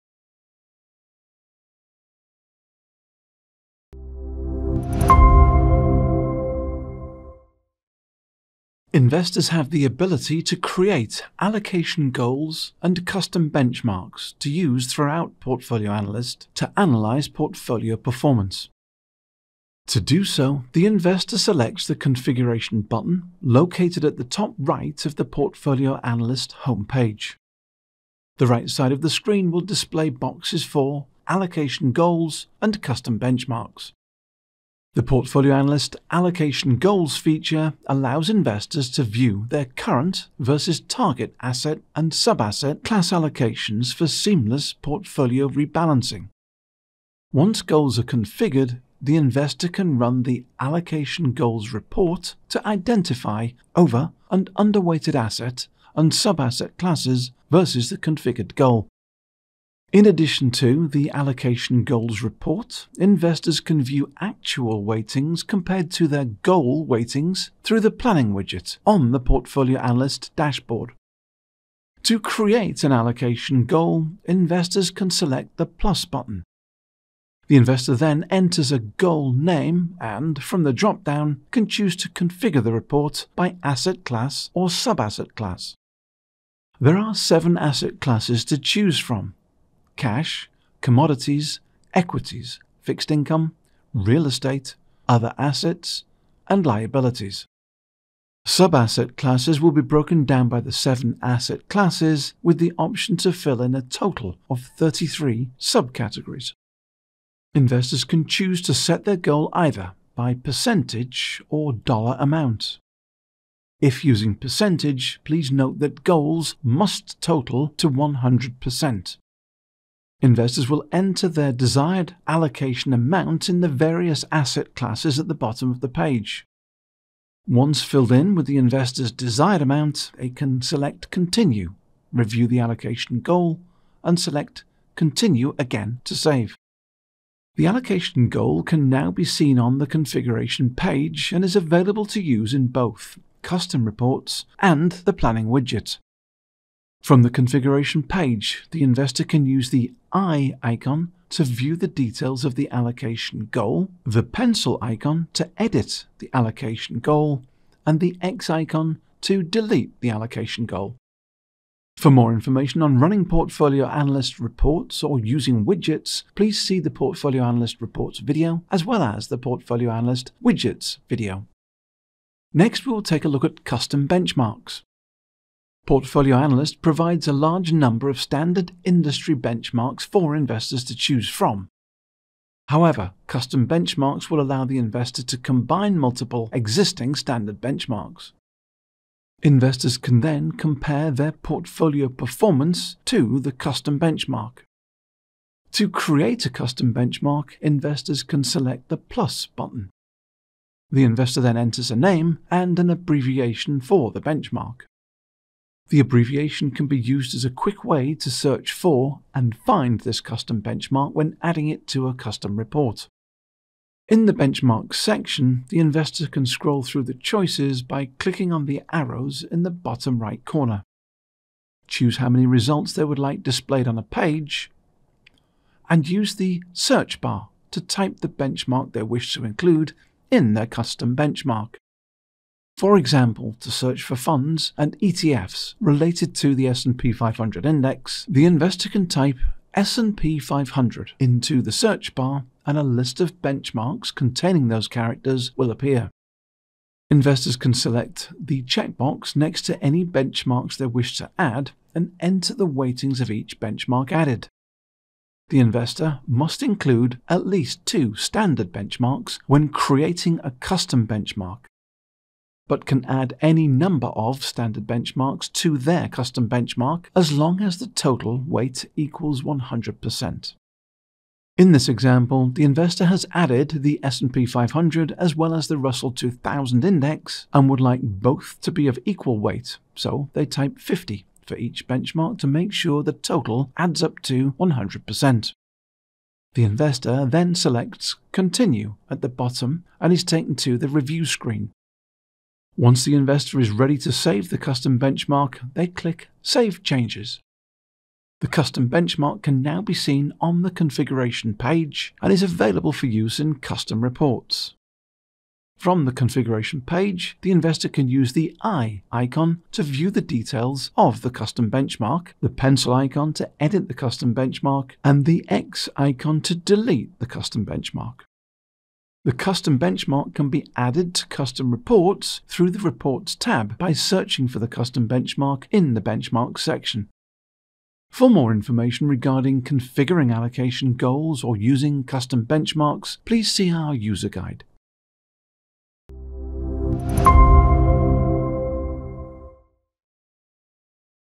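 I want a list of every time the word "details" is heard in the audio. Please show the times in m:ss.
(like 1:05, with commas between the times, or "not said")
2:31, 5:10.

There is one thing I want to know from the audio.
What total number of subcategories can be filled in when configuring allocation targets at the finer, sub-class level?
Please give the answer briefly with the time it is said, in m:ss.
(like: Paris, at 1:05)
33, at 1:44.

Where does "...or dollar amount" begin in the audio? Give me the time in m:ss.
1:51.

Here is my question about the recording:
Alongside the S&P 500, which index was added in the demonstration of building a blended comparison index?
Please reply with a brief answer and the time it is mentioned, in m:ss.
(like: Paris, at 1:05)
Russell 2000, at 4:35.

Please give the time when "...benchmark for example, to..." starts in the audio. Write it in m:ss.
3:51.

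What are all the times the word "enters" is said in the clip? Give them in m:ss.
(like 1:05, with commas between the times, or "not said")
1:18, 2:00, 3:21, 4:12.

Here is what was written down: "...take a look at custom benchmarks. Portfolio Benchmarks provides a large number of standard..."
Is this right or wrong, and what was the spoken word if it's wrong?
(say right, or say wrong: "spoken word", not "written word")
wrong: "Analyst", not "Benchmarks".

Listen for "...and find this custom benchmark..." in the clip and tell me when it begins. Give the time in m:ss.
3:29.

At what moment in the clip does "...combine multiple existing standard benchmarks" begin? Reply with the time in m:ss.
3:05.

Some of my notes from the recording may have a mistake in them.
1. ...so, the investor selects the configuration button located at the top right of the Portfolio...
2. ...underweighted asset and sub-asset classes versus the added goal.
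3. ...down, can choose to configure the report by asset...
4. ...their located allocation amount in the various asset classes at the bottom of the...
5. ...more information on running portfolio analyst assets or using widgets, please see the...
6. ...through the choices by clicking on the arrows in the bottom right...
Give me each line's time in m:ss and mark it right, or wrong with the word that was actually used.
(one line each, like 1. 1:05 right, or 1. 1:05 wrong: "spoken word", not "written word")
1. 0:20 right
2. 0:54 wrong: "configured", not "added"
3. 1:21 right
4. 2:01 wrong: "desired", not "located"
5. 2:42 wrong: "reports", not "assets"
6. 3:36 right.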